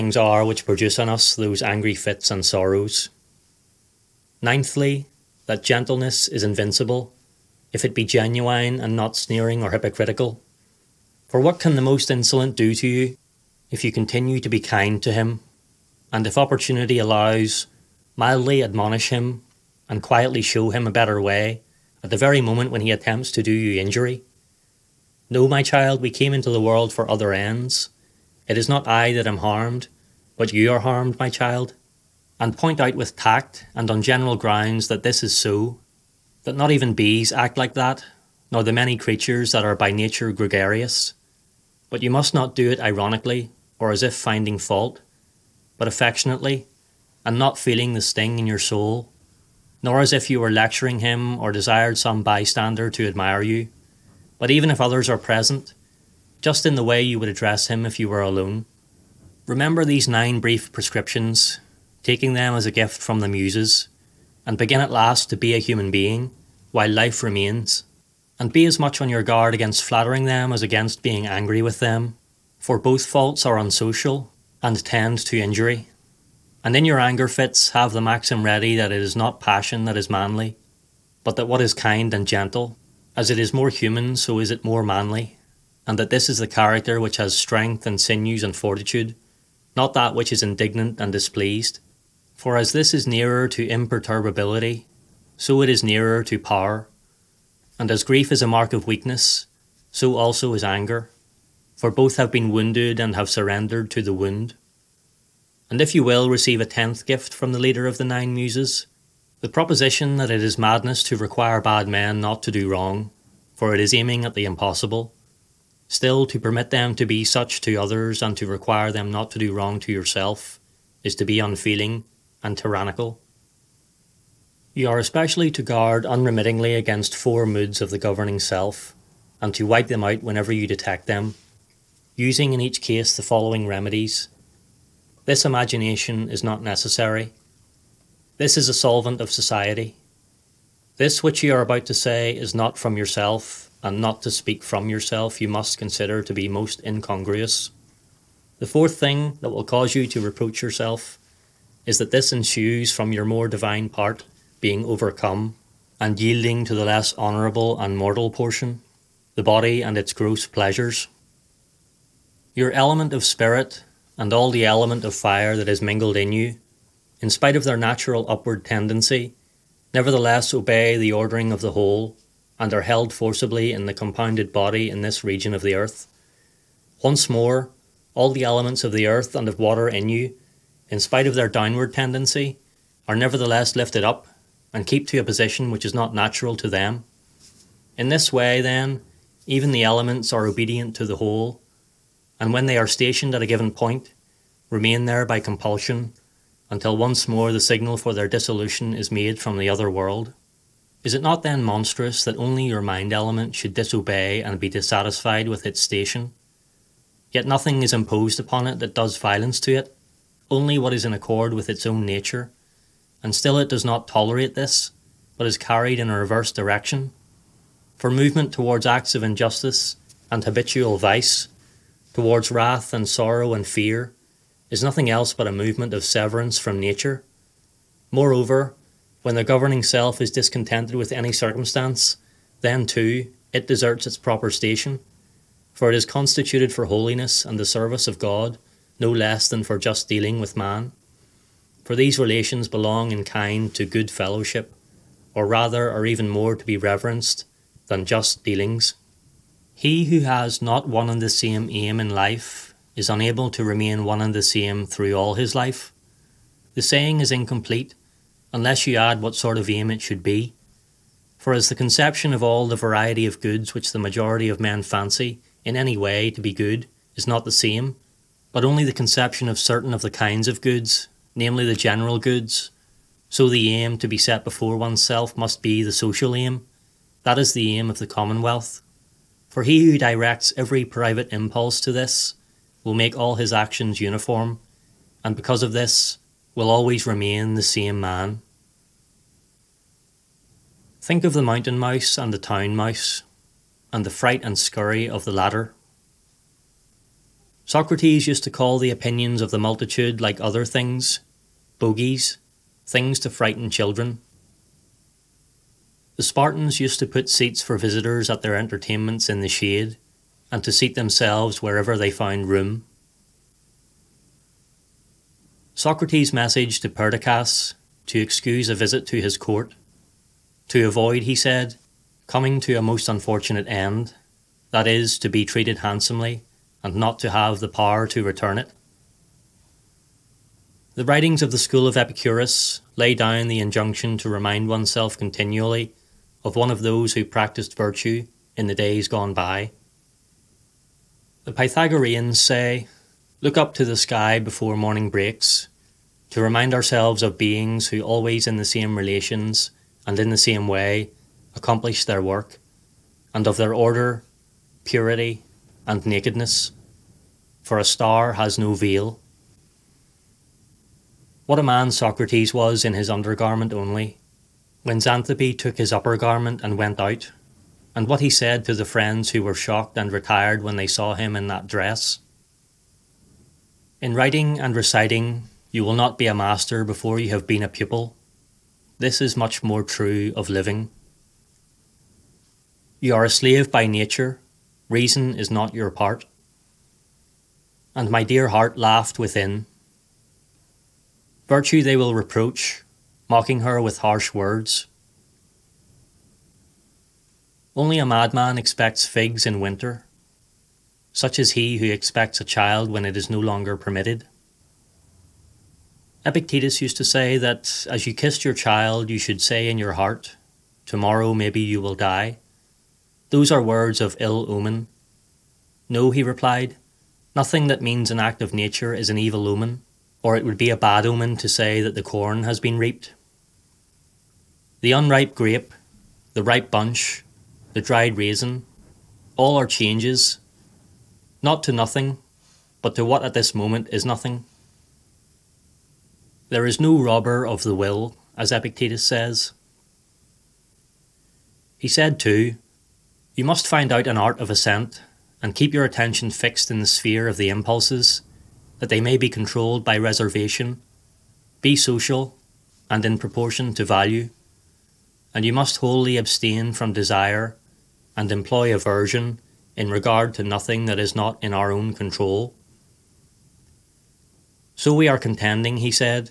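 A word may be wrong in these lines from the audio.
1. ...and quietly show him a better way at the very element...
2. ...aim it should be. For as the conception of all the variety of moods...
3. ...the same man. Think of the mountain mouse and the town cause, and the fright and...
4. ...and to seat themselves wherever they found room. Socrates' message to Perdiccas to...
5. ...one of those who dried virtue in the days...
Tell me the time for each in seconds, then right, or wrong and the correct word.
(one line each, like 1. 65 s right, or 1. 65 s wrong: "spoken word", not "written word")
1. 19 s wrong: "moment", not "element"
2. 259 s wrong: "goods", not "moods"
3. 287 s wrong: "mouse", not "cause"
4. 310 s right
5. 336 s wrong: "practised", not "dried".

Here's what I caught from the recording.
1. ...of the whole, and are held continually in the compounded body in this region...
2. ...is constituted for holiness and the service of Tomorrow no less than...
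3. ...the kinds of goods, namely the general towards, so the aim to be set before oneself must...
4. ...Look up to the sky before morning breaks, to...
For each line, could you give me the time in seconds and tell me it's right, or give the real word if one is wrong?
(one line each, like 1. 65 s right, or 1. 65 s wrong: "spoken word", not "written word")
1. 171 s wrong: "forcibly", not "continually"
2. 235 s wrong: "God", not "Tomorrow"
3. 270 s wrong: "goods", not "towards"
4. 343 s right.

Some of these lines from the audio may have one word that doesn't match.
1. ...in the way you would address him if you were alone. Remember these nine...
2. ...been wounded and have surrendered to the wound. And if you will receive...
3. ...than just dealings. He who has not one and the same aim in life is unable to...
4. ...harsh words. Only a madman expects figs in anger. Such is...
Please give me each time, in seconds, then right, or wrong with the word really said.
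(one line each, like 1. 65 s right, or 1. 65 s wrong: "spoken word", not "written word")
1. 56 s right
2. 102 s right
3. 247 s right
4. 393 s wrong: "winter", not "anger".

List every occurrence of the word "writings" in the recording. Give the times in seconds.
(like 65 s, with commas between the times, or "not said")
331 s, 374 s.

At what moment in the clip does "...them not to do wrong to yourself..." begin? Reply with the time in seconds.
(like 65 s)
118 s.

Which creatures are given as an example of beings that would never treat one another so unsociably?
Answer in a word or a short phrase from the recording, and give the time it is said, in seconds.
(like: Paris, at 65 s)
bees, at 36 s.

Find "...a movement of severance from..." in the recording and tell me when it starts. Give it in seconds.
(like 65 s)
225 s.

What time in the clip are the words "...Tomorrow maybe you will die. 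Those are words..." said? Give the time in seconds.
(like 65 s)
410 s.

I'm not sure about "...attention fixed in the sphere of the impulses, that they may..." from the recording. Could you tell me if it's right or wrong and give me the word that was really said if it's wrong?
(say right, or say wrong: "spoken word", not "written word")
right.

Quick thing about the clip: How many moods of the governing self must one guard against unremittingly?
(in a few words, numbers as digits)
4.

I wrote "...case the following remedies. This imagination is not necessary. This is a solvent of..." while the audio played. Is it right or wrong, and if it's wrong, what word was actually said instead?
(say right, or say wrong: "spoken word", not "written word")
right.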